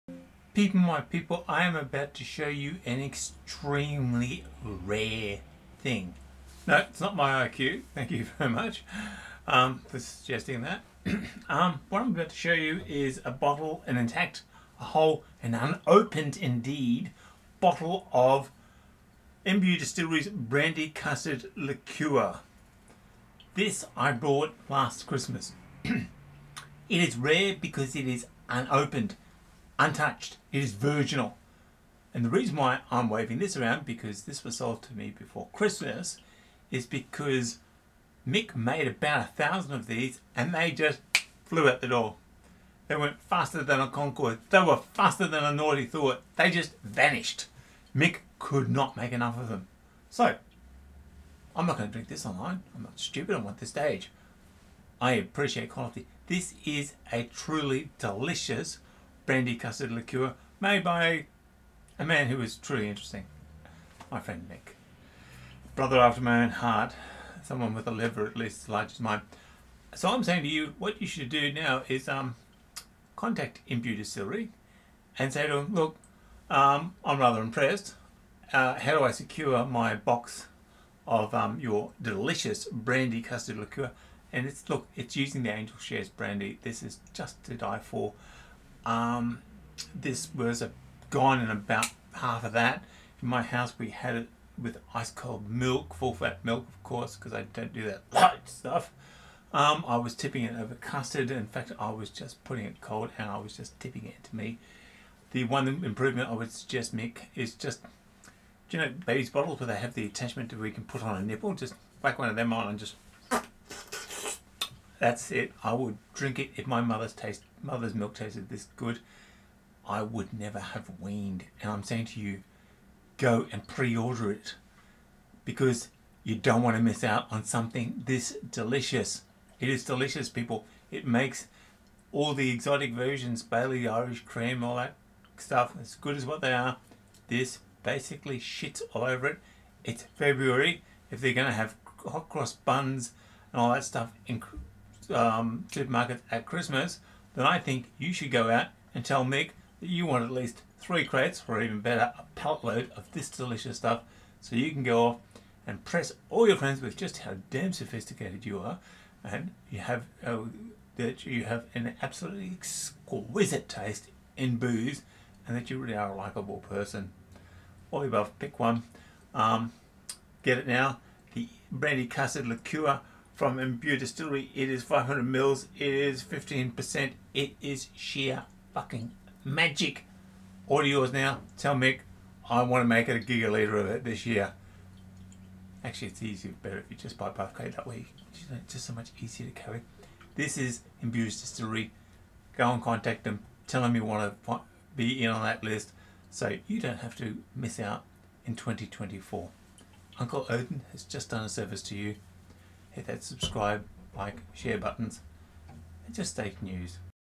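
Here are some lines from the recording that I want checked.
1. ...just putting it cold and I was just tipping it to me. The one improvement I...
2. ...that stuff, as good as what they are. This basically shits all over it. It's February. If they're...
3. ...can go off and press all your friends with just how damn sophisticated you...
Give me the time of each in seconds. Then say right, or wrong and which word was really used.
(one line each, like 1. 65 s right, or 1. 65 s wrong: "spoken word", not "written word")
1. 102 s right
2. 134 s right
3. 154 s right.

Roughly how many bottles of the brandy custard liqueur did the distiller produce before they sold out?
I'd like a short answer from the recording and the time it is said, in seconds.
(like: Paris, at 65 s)
1000, at 38 s.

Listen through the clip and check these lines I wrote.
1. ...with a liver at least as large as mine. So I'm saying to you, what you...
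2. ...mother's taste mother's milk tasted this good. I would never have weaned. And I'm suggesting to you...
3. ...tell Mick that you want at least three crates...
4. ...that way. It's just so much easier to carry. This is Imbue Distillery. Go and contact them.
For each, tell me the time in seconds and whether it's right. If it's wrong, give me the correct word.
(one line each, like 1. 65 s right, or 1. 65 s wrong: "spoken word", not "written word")
1. 67 s right
2. 116 s wrong: "saying", not "suggesting"
3. 149 s right
4. 187 s right.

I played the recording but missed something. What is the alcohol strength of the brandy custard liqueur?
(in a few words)
15%.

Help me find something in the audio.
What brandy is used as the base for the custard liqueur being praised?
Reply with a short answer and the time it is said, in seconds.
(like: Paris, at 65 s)
Angel Shares, at 85 s.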